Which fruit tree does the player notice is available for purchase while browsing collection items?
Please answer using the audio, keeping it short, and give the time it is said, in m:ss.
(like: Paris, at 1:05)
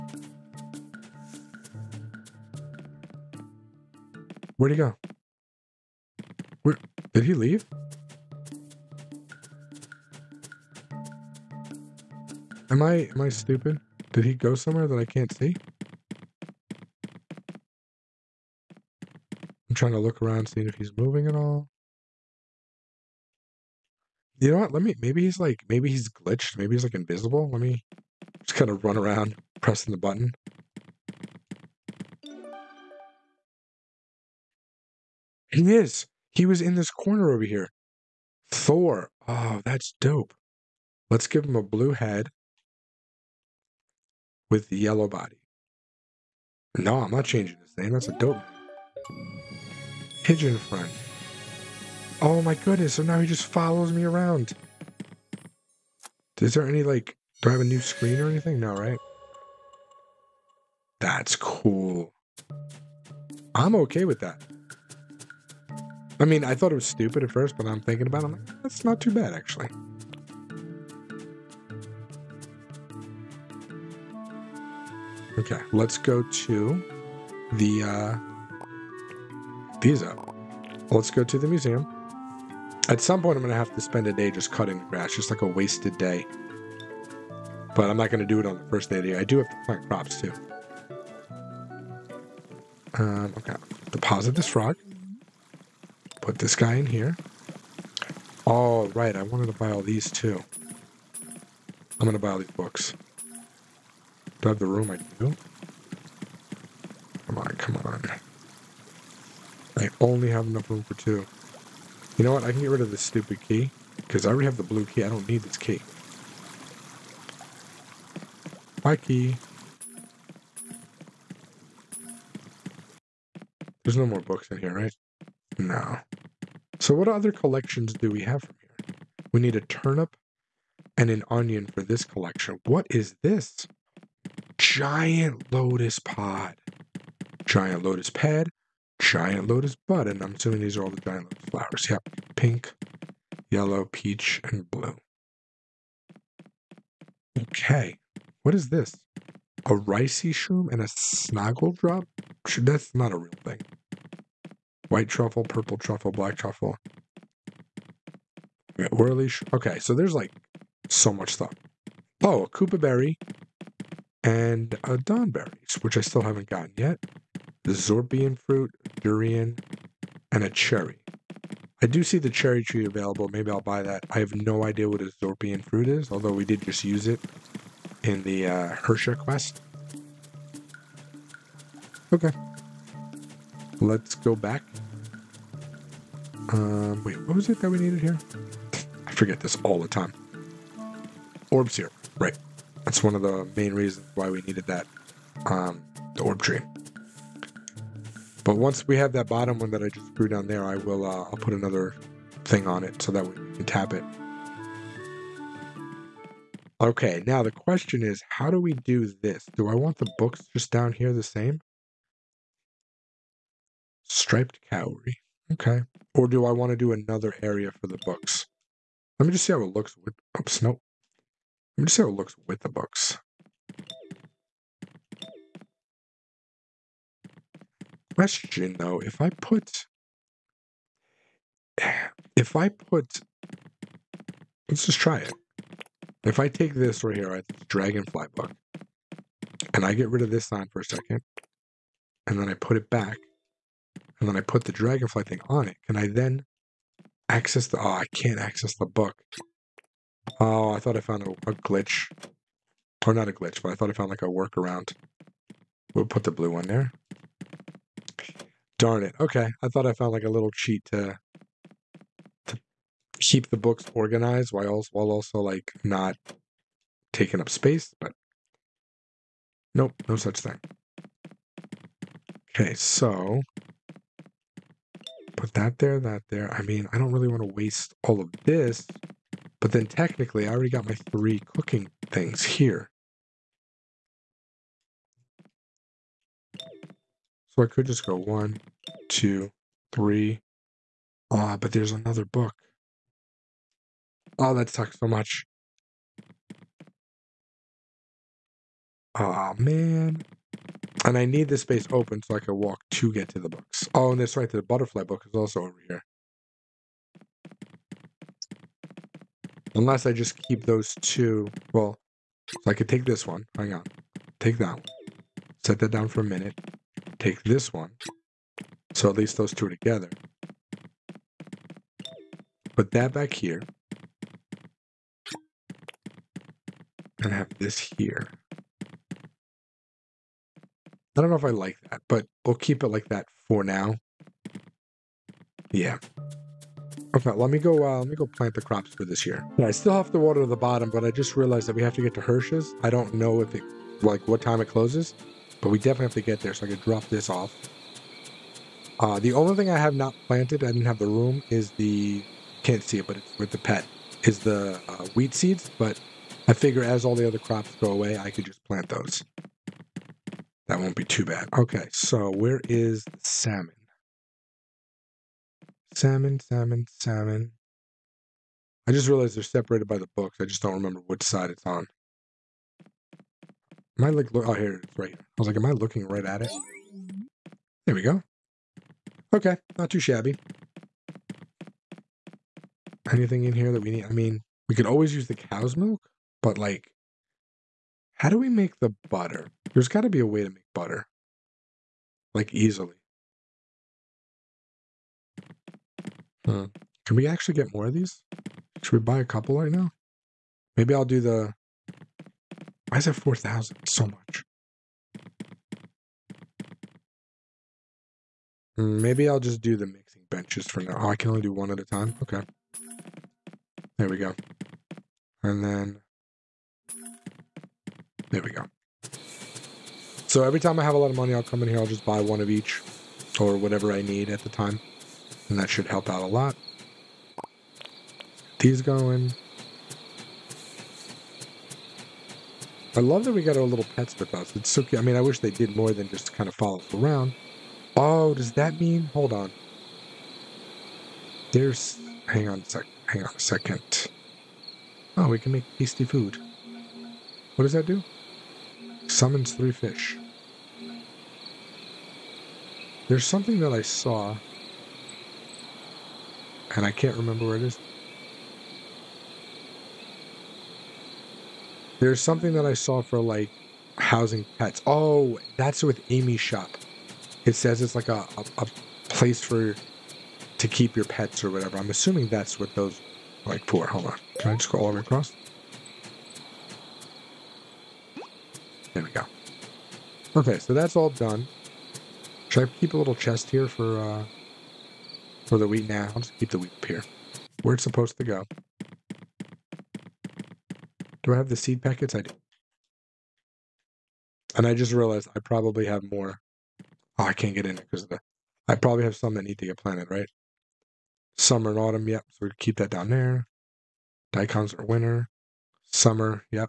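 cherry tree, at 2:52.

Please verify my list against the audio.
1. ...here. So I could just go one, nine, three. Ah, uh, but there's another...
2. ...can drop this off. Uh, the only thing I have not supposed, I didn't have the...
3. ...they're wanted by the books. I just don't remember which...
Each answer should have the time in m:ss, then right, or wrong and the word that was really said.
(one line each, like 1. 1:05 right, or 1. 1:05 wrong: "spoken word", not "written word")
1. 4:42 wrong: "two", not "nine"
2. 5:46 wrong: "planted", not "supposed"
3. 6:09 wrong: "separated", not "wanted".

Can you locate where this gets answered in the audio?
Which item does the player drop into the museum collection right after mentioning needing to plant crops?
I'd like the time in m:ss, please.
1:34.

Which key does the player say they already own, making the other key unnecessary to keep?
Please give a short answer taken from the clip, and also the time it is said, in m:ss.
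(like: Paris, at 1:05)
blue key, at 1:54.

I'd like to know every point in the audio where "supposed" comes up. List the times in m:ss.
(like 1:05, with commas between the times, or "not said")
8:07.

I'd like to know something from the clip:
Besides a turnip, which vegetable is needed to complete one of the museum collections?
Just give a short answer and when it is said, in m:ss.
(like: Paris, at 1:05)
onion, at 2:11.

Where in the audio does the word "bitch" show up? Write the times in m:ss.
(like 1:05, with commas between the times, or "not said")
not said.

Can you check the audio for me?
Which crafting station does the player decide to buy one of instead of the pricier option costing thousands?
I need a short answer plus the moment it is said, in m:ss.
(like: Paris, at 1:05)
mixing benches, at 6:49.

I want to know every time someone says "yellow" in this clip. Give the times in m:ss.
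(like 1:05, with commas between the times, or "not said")
0:44, 2:23.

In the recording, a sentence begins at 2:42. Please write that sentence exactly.
Oh, a Kobo berry and a Donberries, which I still haven't gotten yet.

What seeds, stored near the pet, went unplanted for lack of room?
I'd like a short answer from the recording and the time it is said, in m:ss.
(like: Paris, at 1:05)
wheat seeds, at 5:55.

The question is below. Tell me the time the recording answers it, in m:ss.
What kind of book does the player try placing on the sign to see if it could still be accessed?
3:57.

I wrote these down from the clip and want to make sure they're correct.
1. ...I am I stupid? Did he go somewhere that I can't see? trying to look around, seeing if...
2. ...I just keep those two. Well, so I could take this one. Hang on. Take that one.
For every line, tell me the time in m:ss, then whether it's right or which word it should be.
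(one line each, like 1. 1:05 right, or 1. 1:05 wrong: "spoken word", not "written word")
1. 0:12 right
2. 5:10 right.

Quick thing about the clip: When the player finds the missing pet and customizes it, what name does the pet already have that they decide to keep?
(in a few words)
Thor.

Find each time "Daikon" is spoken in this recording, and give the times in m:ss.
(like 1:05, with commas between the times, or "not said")
8:24.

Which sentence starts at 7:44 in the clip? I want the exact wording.
Oh, that's with Amy's shop it says it's like a, a, a place for to keep your pets or whatever.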